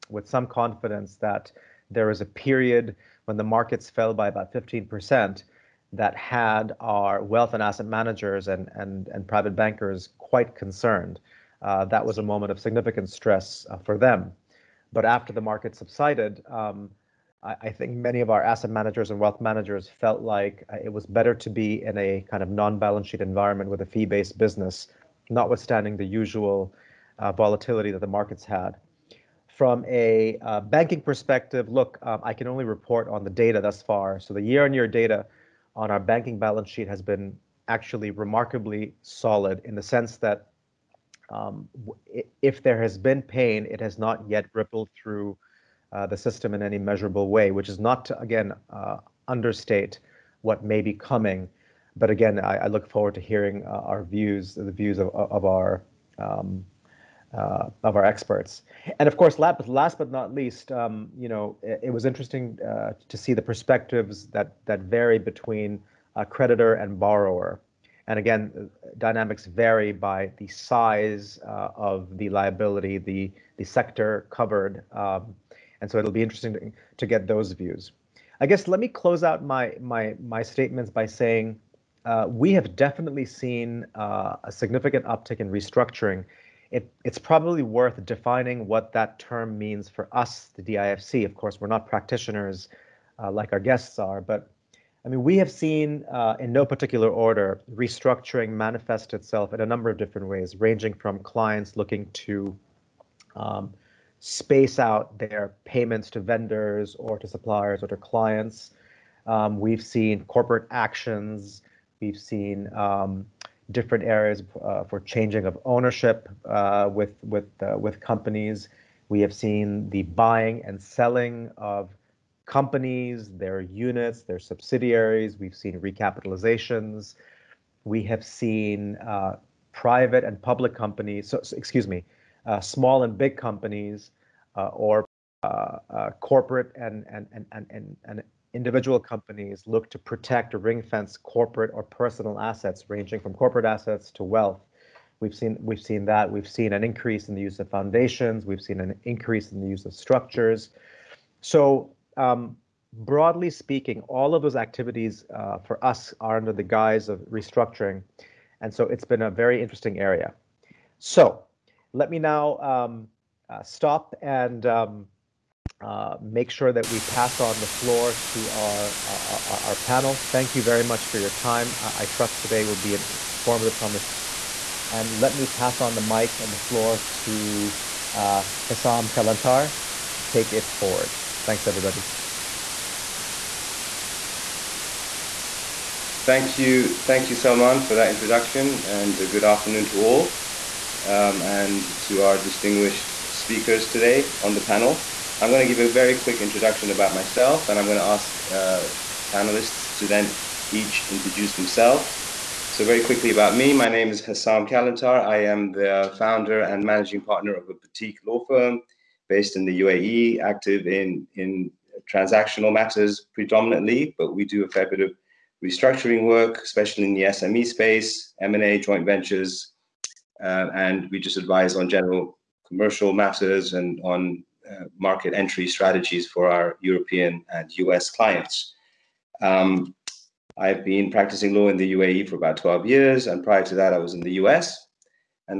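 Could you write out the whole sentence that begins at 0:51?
But again, I, I look forward to hearing uh, our views, the views of, of our um, uh, of our experts.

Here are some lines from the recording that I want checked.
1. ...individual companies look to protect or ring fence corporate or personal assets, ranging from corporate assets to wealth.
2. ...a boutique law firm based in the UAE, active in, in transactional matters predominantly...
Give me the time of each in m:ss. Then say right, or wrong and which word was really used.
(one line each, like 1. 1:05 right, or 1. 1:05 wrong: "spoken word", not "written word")
1. 2:18 right
2. 3:27 right.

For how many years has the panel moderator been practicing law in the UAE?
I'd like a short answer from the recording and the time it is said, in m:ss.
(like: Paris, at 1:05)
12, at 3:52.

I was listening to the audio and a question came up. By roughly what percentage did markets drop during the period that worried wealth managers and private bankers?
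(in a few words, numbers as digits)
15%.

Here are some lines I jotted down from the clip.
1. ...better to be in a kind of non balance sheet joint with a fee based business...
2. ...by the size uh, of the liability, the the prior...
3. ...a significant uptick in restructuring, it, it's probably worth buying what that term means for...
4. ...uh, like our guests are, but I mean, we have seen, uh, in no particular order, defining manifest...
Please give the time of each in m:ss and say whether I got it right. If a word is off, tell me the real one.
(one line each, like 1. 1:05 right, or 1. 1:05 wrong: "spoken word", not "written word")
1. 0:21 wrong: "environment", not "joint"
2. 1:09 wrong: "sector", not "prior"
3. 1:23 wrong: "defining", not "buying"
4. 1:33 wrong: "restructuring", not "defining".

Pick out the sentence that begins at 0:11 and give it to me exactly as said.
Uh, that was a moment of significant stress uh, for them.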